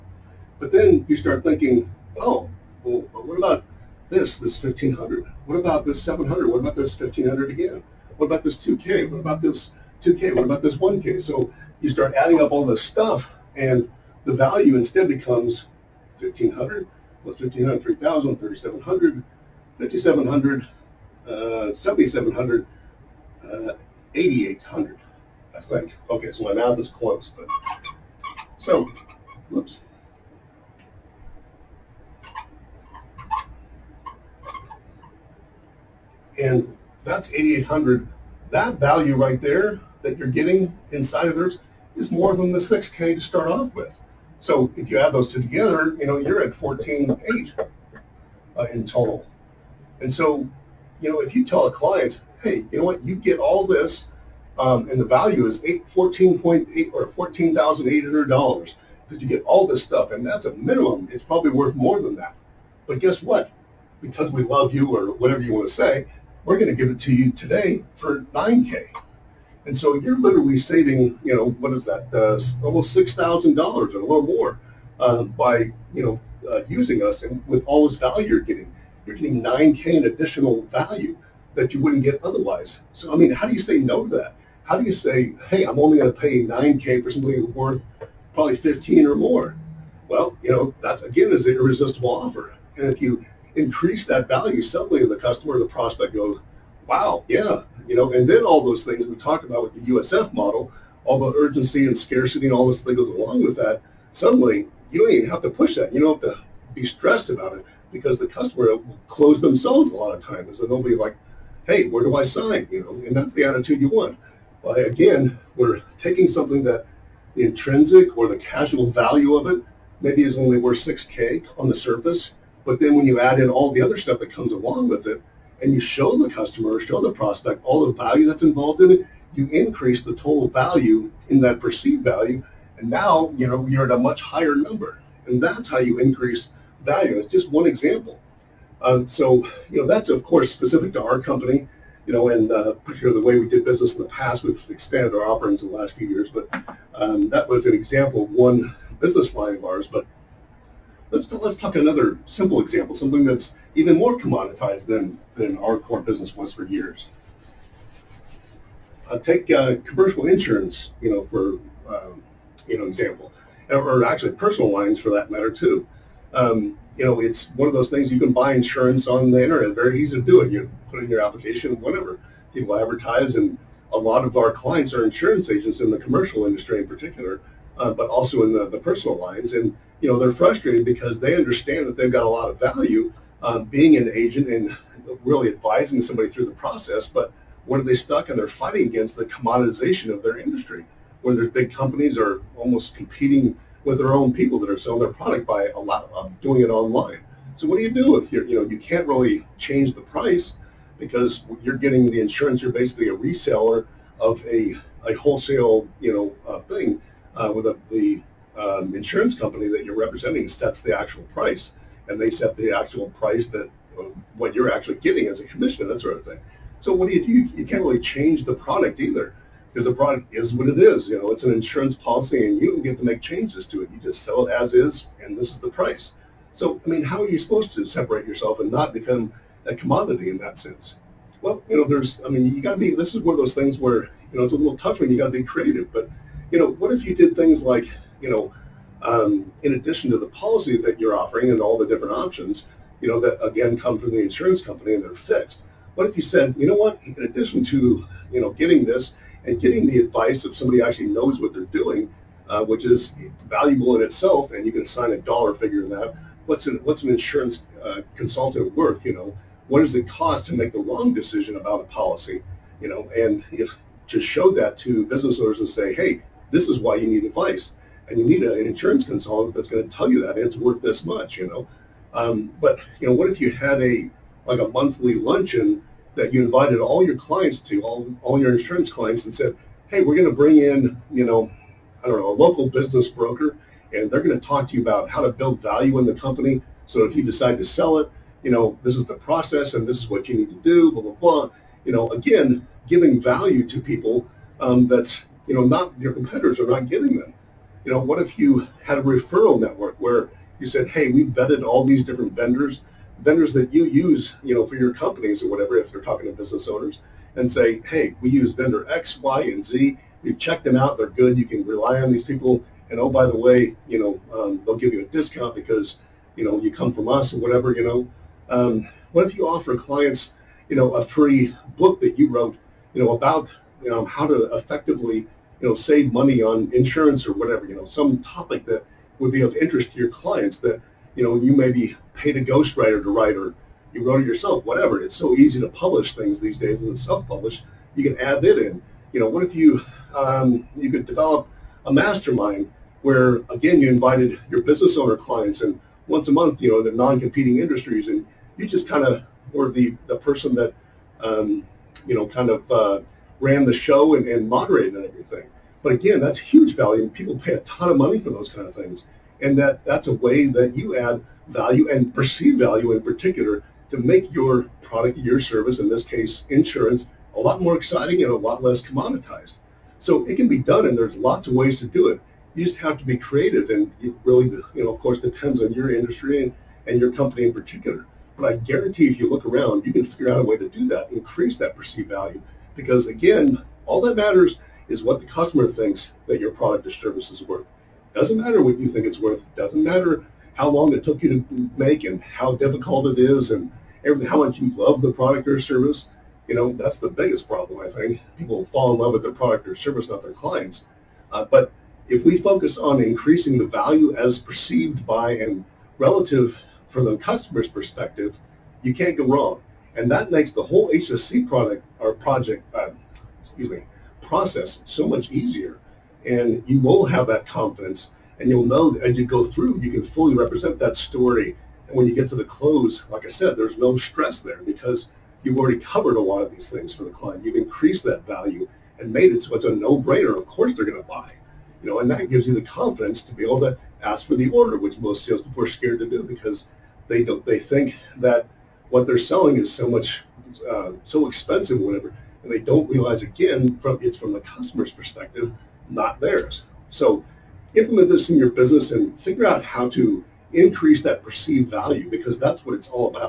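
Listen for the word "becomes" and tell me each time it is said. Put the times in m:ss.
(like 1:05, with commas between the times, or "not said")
0:15, 3:48.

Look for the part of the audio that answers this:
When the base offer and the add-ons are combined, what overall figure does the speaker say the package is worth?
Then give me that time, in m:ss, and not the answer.
0:57.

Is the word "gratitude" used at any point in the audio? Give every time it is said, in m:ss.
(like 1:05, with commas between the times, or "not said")
not said.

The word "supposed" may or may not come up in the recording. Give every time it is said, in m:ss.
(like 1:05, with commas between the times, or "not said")
3:47.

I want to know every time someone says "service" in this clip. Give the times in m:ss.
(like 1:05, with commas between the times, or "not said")
6:05, 6:26, 6:35, 6:39.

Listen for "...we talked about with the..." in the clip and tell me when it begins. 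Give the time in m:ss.
1:39.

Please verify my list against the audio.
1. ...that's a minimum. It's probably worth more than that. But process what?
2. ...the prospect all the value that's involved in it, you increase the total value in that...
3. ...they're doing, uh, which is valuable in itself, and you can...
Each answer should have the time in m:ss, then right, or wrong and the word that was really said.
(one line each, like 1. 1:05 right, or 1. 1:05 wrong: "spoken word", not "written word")
1. 1:00 wrong: "guess", not "process"
2. 2:07 right
3. 4:11 right.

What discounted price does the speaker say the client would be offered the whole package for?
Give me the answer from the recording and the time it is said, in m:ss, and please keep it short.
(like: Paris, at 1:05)
9K, at 1:07.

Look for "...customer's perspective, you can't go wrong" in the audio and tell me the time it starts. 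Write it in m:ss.
6:47.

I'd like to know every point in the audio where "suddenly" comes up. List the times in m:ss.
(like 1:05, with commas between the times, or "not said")
1:34, 1:44.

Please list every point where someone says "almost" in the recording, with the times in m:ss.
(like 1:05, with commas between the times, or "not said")
1:12, 3:12.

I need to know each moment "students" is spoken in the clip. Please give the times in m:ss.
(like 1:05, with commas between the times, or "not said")
not said.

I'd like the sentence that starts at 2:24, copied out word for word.
We've expanded our offerings in the last few years, but um, that was an example of one business line of ours.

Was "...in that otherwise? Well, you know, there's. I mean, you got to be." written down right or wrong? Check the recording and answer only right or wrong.
wrong.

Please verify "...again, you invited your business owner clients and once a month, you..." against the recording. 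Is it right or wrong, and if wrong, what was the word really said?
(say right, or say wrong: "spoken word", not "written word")
right.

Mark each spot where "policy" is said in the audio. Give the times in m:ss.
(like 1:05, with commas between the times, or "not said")
3:41, 4:00, 4:21.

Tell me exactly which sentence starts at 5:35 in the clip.
It's so easy to publish things these days and self-publish.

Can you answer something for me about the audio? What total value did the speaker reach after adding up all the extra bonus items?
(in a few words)
8,800.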